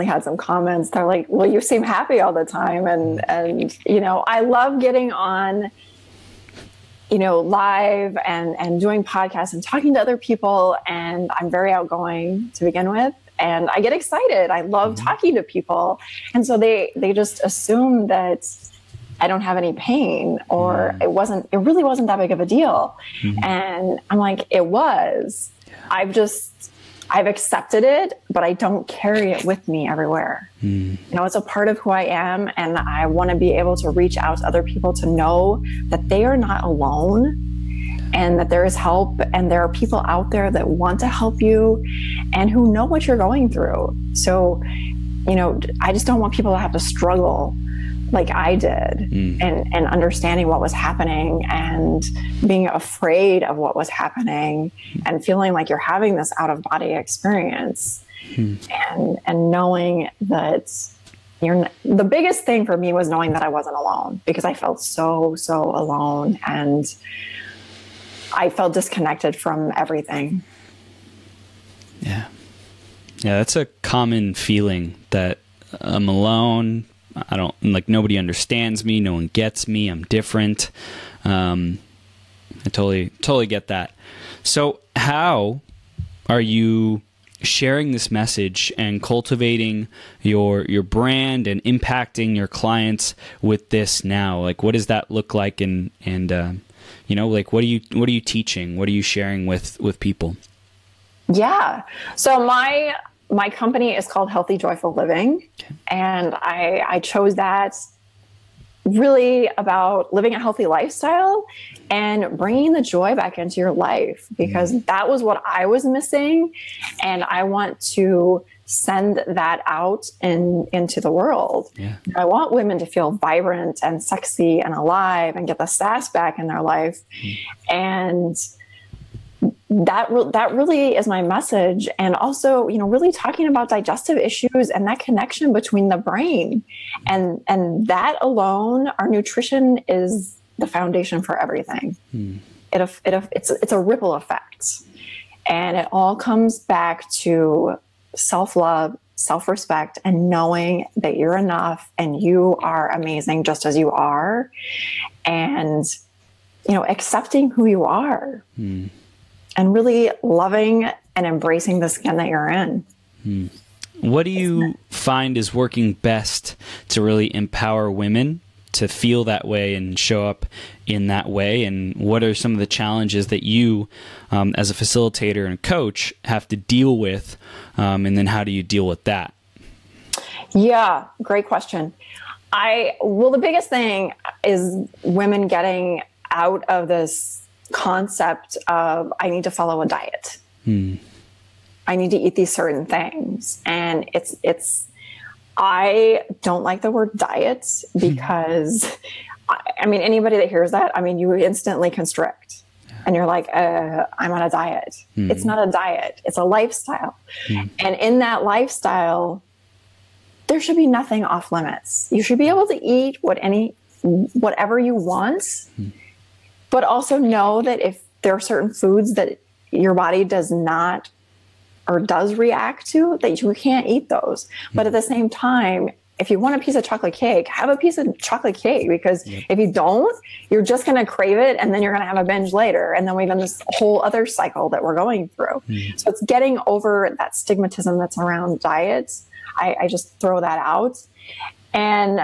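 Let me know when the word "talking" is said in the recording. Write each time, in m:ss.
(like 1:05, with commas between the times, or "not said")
0:09, 0:15, 2:13.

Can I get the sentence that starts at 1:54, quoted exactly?
that was what I was missing, and I want to send that out in, into the world.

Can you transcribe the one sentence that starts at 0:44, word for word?
So, you know, I just don't want people to have to struggle like I did mm.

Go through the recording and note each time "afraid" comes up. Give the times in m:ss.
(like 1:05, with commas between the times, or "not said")
0:52.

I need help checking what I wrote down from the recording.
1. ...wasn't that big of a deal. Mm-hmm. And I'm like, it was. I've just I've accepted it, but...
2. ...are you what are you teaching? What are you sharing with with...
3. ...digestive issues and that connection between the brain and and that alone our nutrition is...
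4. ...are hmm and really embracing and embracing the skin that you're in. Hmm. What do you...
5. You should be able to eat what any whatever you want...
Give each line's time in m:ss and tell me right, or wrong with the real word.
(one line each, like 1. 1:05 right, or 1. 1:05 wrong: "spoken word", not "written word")
1. 0:21 right
2. 1:37 right
3. 2:13 right
4. 2:37 wrong: "loving", not "embracing"
5. 3:32 right.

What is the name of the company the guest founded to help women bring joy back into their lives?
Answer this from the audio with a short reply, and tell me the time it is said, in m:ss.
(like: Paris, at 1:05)
Healthy Joyful Living, at 1:44.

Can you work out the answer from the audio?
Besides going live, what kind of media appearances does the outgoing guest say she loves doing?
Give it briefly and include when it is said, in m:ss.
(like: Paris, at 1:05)
podcasts, at 0:09.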